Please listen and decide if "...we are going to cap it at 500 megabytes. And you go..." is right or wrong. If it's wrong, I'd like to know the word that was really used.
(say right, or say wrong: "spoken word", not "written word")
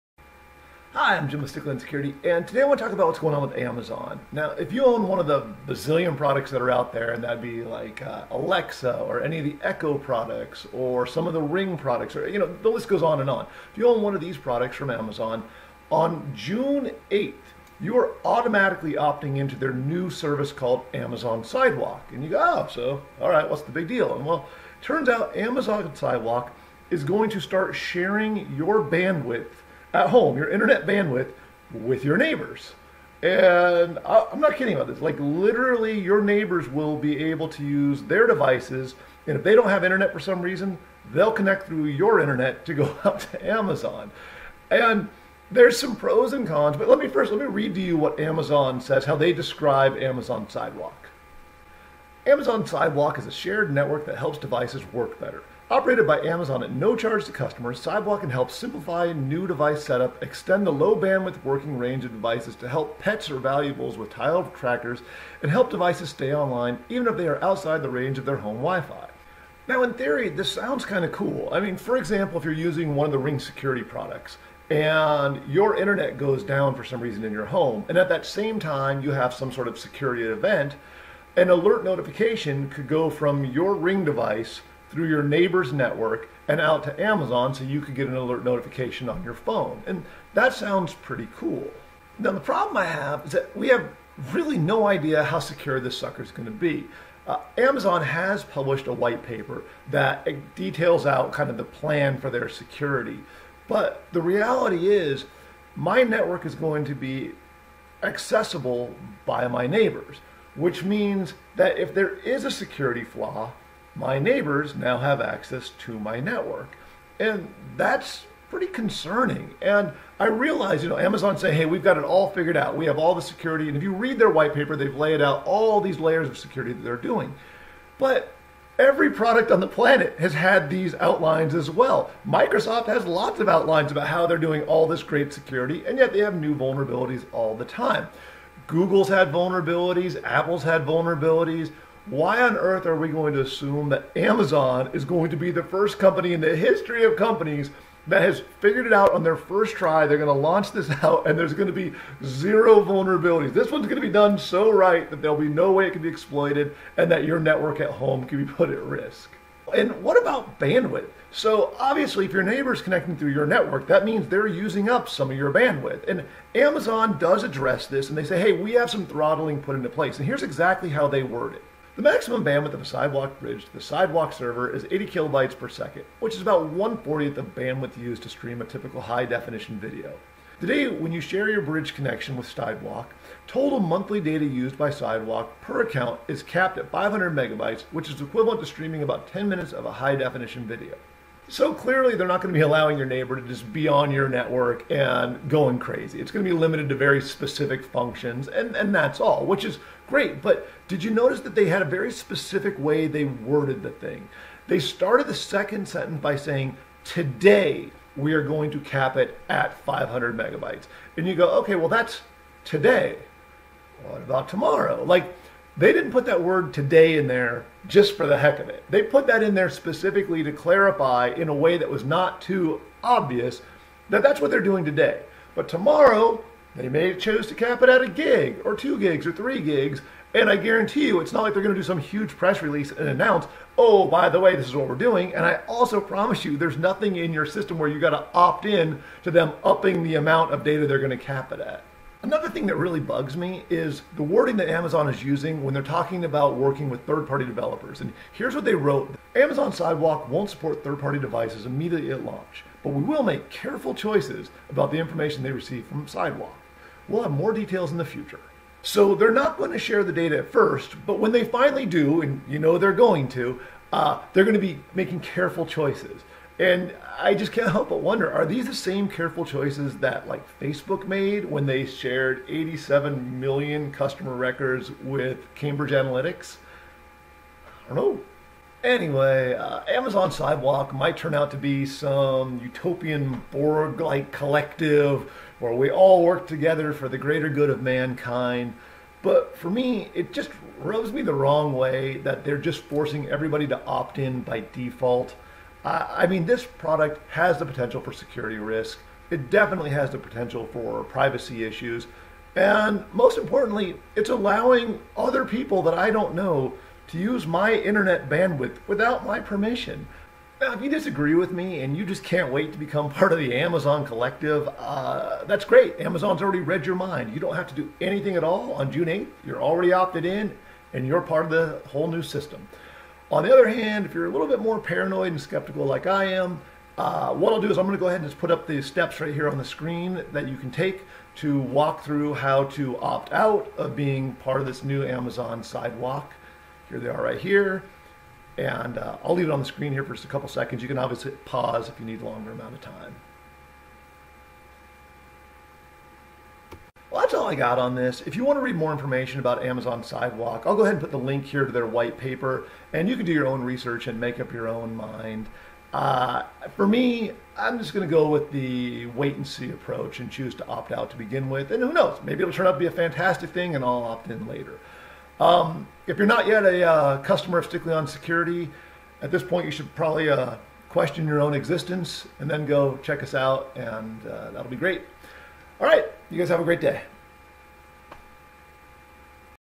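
right.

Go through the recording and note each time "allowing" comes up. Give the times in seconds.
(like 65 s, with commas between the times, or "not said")
192 s, 304 s.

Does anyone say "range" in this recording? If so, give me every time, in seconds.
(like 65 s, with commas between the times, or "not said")
61 s, 67 s.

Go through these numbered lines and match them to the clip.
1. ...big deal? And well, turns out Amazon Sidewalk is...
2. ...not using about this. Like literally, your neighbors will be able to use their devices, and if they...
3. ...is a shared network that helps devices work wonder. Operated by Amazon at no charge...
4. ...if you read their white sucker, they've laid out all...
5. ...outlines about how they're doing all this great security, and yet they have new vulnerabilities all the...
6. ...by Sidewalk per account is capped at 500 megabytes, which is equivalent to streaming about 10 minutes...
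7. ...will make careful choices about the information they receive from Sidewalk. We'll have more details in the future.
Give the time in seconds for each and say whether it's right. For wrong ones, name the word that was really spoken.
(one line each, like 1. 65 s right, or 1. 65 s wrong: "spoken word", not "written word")
1. 23 s right
2. 34 s wrong: "kidding", not "using"
3. 53 s wrong: "better", not "wonder"
4. 123 s wrong: "paper", not "sucker"
5. 133 s right
6. 184 s right
7. 253 s right.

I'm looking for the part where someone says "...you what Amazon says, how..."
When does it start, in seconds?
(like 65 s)
47 s.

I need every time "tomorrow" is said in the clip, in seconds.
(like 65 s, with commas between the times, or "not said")
214 s, 225 s.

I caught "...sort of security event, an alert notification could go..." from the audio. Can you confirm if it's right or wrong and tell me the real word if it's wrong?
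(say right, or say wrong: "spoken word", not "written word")
right.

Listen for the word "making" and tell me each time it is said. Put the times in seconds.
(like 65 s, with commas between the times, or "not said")
264 s.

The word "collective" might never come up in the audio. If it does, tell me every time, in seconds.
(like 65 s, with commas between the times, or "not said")
284 s, 314 s.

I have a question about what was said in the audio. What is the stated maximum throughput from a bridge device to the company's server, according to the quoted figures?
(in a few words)
80 kilobytes per second.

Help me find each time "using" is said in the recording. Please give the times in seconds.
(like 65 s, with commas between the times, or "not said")
72 s, 164 s, 245 s.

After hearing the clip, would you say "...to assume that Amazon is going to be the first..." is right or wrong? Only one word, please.
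right.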